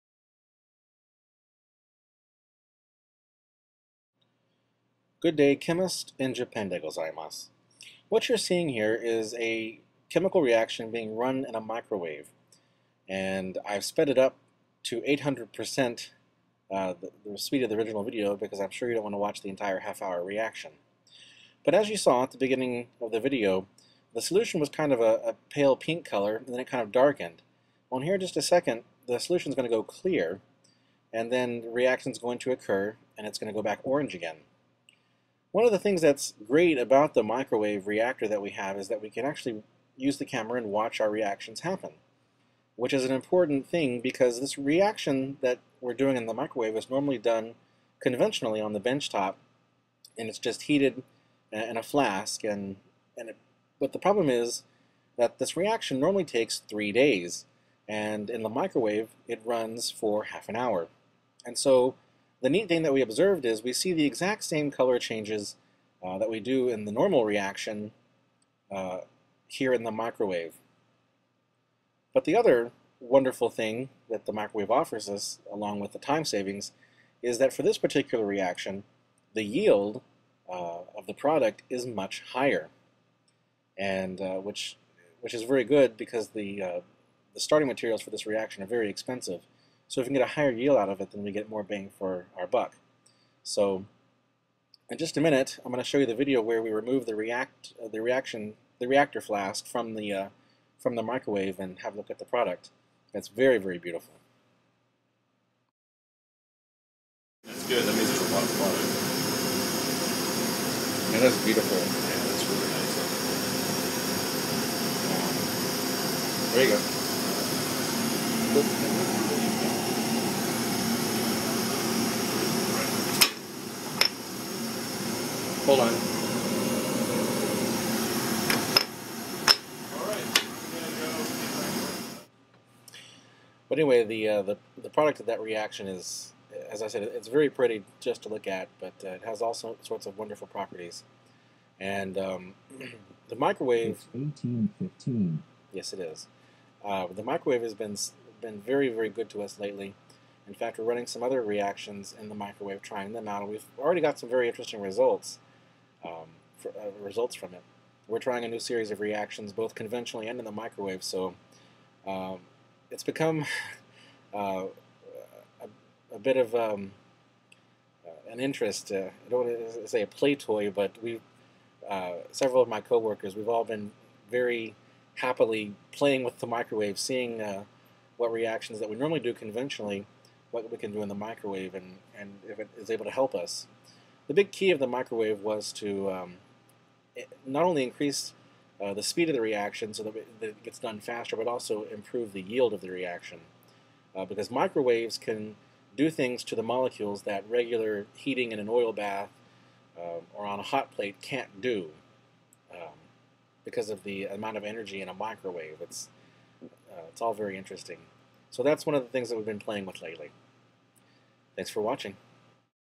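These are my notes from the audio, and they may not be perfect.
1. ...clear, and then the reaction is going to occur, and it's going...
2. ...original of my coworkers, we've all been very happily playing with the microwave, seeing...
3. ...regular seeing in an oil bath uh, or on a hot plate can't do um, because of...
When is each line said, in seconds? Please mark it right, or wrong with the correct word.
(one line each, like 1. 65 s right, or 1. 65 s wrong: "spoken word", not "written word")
1. 29 s right
2. 172 s wrong: "several", not "original"
3. 197 s wrong: "heating", not "seeing".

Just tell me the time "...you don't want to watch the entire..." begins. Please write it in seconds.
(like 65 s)
18 s.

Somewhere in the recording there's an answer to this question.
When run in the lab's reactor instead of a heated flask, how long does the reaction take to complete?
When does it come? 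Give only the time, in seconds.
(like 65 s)
60 s.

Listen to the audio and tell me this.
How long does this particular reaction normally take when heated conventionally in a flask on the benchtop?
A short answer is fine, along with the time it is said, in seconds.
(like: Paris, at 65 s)
3 days, at 56 s.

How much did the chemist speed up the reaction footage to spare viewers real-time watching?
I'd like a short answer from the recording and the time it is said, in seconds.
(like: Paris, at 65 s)
800%, at 15 s.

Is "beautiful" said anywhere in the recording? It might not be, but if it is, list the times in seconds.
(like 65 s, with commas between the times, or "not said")
103 s, 111 s.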